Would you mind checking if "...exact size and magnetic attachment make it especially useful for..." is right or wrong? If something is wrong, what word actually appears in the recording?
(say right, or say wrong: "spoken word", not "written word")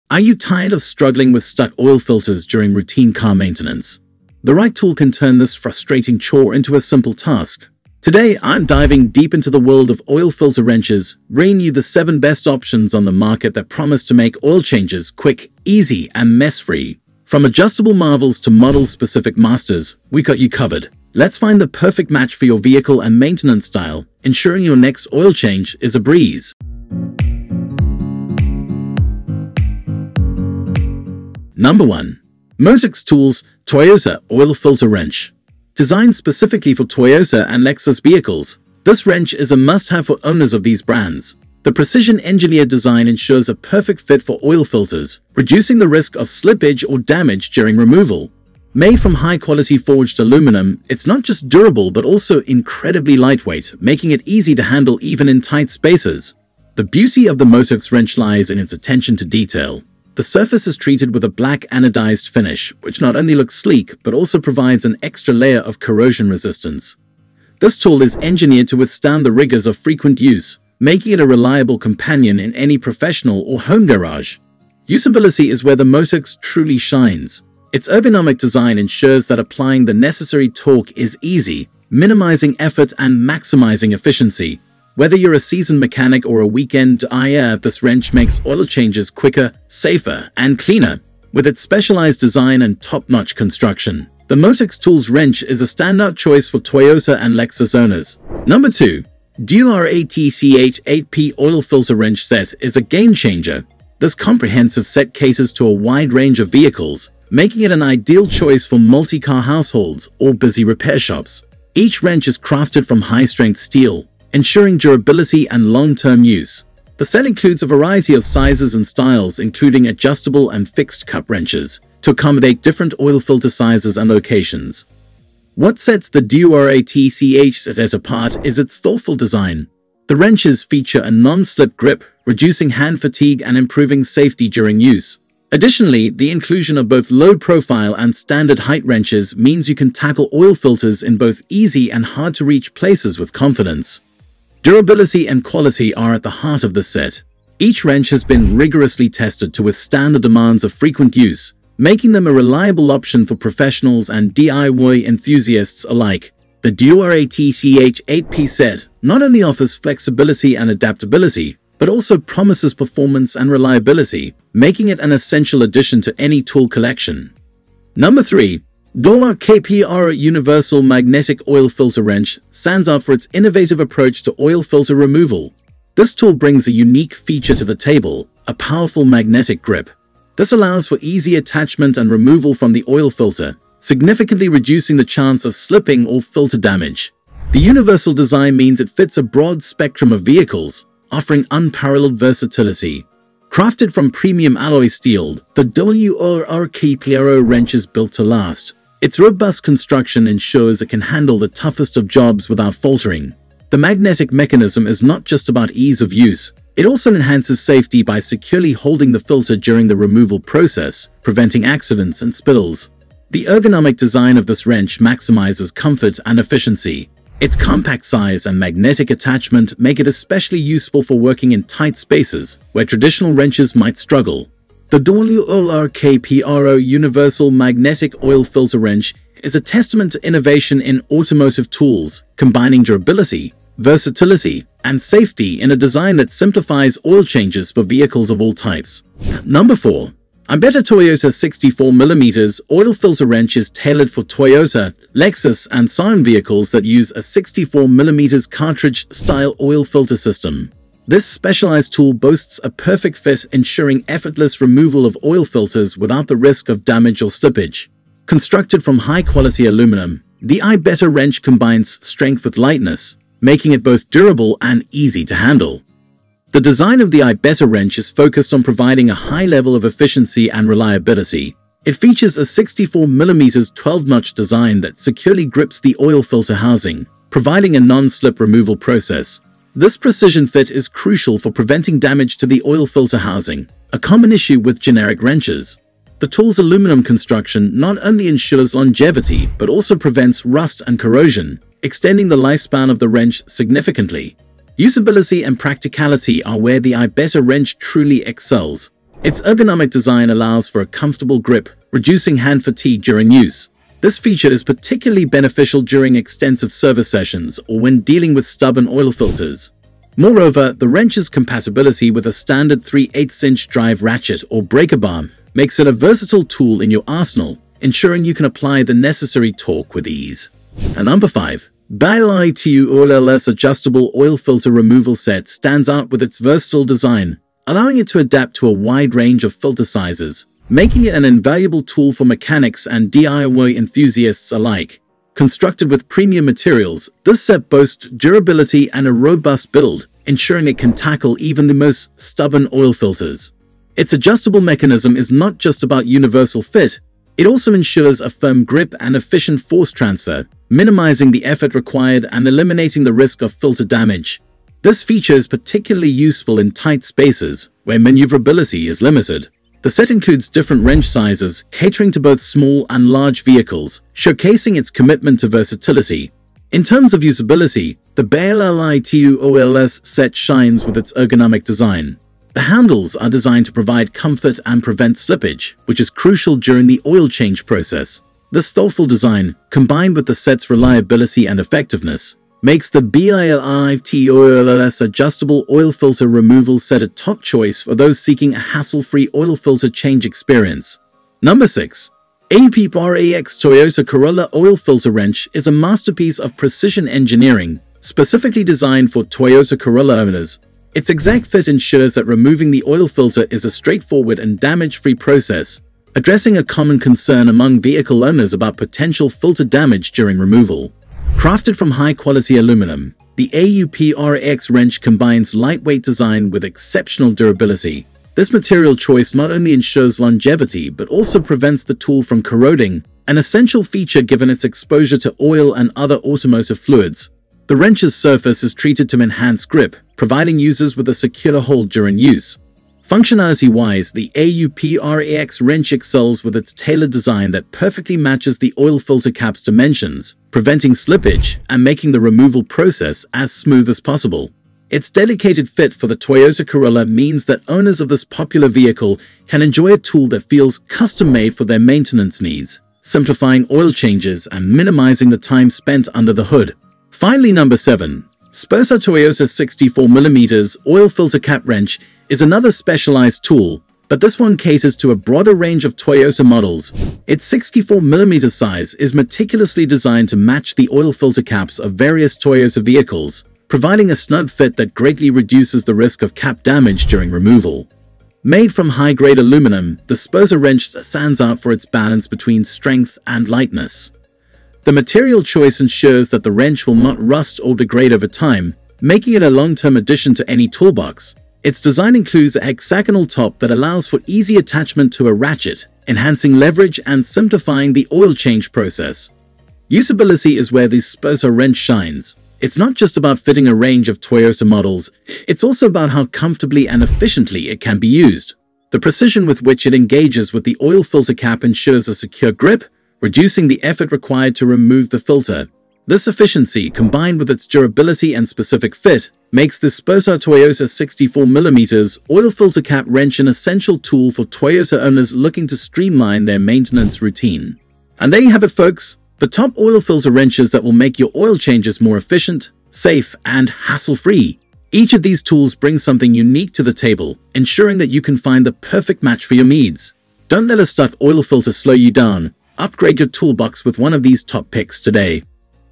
wrong: "compact", not "exact".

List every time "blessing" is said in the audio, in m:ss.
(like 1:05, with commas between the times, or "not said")
not said.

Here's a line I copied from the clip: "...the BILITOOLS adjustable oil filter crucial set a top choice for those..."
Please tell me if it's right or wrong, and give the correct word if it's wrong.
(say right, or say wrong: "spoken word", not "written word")
wrong: "removal", not "crucial".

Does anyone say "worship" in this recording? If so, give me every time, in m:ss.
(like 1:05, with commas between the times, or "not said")
not said.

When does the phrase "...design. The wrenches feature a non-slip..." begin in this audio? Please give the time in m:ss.
2:09.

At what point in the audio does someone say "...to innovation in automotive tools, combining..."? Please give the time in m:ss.
3:50.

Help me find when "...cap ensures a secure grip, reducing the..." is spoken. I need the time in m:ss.
8:31.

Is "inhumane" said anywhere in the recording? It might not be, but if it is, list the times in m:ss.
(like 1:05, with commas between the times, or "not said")
not said.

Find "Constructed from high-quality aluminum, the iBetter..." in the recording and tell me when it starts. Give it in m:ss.
4:18.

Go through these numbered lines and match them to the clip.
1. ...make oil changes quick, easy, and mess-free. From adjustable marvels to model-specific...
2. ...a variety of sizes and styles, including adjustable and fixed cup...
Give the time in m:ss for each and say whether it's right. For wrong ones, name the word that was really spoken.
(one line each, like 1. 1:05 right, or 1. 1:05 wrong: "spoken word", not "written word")
1. 0:14 right
2. 1:57 right.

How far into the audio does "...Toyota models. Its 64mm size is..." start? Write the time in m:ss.
7:45.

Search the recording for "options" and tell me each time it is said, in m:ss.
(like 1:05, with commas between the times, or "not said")
0:12, 2:32.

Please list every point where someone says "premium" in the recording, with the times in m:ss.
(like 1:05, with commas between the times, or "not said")
3:14, 5:36.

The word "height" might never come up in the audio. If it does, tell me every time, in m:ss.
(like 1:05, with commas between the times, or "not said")
2:18.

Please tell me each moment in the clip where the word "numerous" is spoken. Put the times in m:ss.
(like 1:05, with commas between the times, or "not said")
not said.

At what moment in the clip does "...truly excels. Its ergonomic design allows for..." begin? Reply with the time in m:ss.
4:57.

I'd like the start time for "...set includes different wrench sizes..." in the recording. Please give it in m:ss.
5:59.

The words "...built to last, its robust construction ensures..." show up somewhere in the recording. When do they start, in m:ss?
3:17.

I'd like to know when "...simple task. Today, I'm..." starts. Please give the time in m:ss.
0:06.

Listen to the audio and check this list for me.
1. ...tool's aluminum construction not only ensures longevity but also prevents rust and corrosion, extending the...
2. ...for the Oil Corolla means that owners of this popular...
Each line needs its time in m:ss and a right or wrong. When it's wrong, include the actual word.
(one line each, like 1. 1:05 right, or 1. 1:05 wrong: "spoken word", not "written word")
1. 4:46 right
2. 7:25 wrong: "Toyota", not "Oil".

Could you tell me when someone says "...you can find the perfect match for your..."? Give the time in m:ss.
8:58.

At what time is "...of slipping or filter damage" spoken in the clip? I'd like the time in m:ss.
3:05.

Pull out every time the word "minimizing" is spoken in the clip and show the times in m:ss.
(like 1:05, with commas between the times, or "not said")
1:21, 5:50, 7:34.